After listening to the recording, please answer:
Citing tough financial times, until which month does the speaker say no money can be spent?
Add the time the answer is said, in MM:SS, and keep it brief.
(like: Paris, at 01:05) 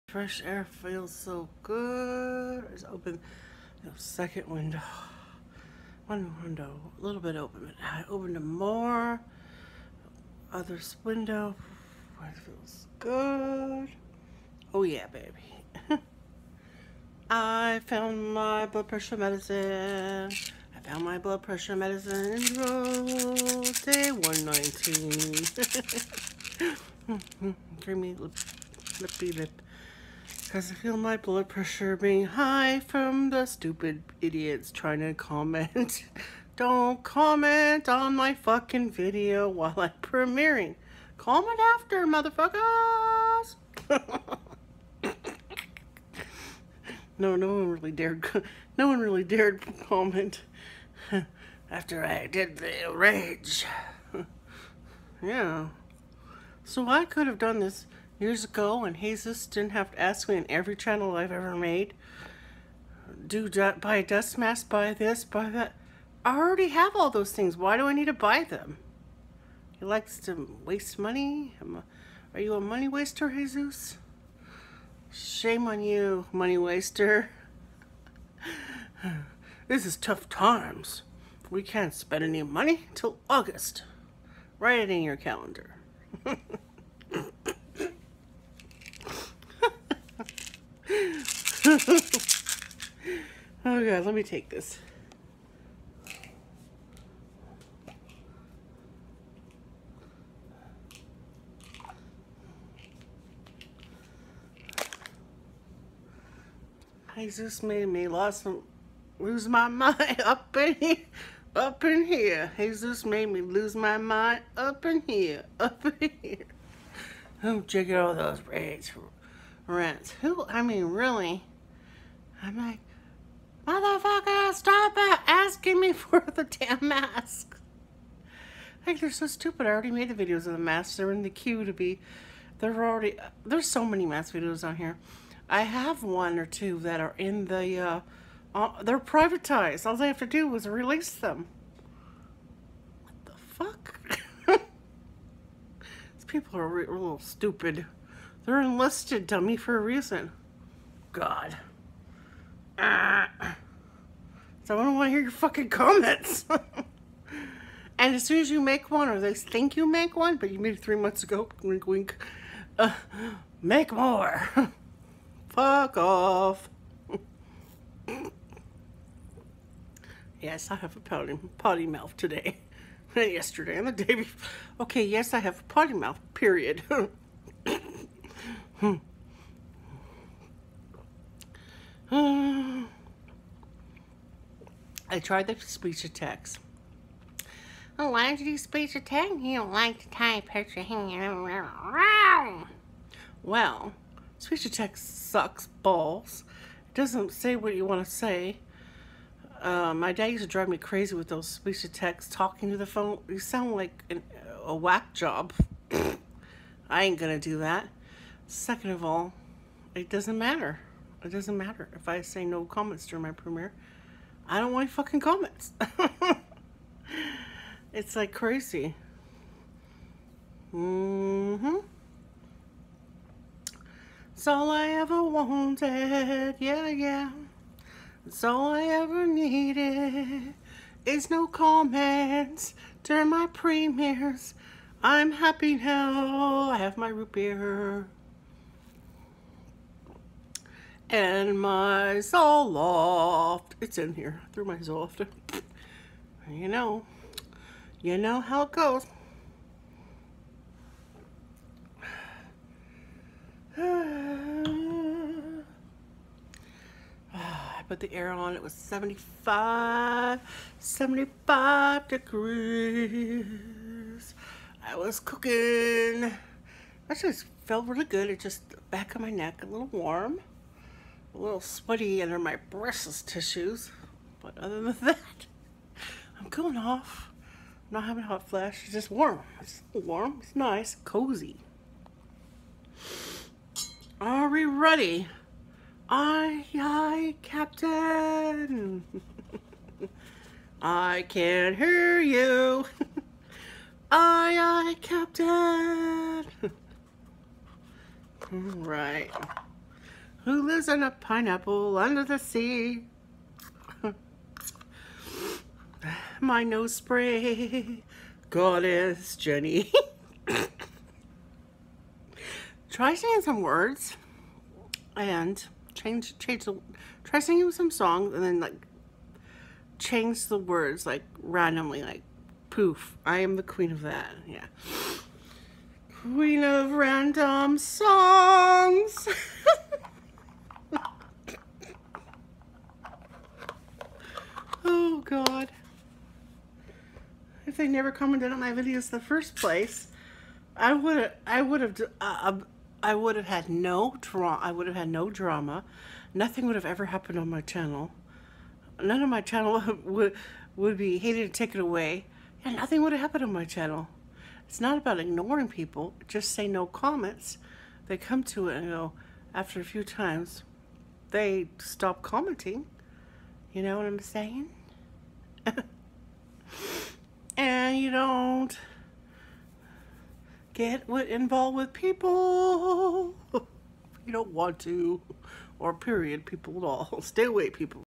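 August, at 01:23.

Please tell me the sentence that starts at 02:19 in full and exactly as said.
All they have to do was release them.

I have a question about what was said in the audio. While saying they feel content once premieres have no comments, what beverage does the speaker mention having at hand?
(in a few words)
Root beer.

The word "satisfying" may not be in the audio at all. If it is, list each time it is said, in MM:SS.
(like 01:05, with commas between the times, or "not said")
not said.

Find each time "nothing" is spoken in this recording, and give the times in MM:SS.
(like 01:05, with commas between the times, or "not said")
05:46, 05:52.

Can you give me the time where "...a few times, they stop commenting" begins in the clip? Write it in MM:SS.
05:59.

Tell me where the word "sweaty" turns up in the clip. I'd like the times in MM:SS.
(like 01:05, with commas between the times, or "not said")
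04:31.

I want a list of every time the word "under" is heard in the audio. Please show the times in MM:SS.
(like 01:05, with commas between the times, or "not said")
04:32, 05:01.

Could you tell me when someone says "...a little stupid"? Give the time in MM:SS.
02:26.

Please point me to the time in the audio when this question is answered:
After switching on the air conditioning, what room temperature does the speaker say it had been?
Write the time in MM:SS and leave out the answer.
04:20.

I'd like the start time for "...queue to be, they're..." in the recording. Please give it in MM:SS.
02:11.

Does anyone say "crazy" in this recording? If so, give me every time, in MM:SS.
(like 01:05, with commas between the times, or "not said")
03:20, 03:38.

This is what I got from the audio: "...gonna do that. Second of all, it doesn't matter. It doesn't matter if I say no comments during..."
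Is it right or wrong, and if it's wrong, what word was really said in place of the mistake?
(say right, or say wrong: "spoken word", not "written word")
right.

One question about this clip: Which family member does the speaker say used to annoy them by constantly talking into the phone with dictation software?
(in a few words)
Dad.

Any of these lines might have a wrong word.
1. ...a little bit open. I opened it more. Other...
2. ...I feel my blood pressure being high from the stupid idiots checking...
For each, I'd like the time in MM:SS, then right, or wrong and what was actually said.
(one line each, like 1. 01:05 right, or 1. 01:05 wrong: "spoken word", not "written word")
1. 00:06 right
2. 00:30 wrong: "trying", not "checking".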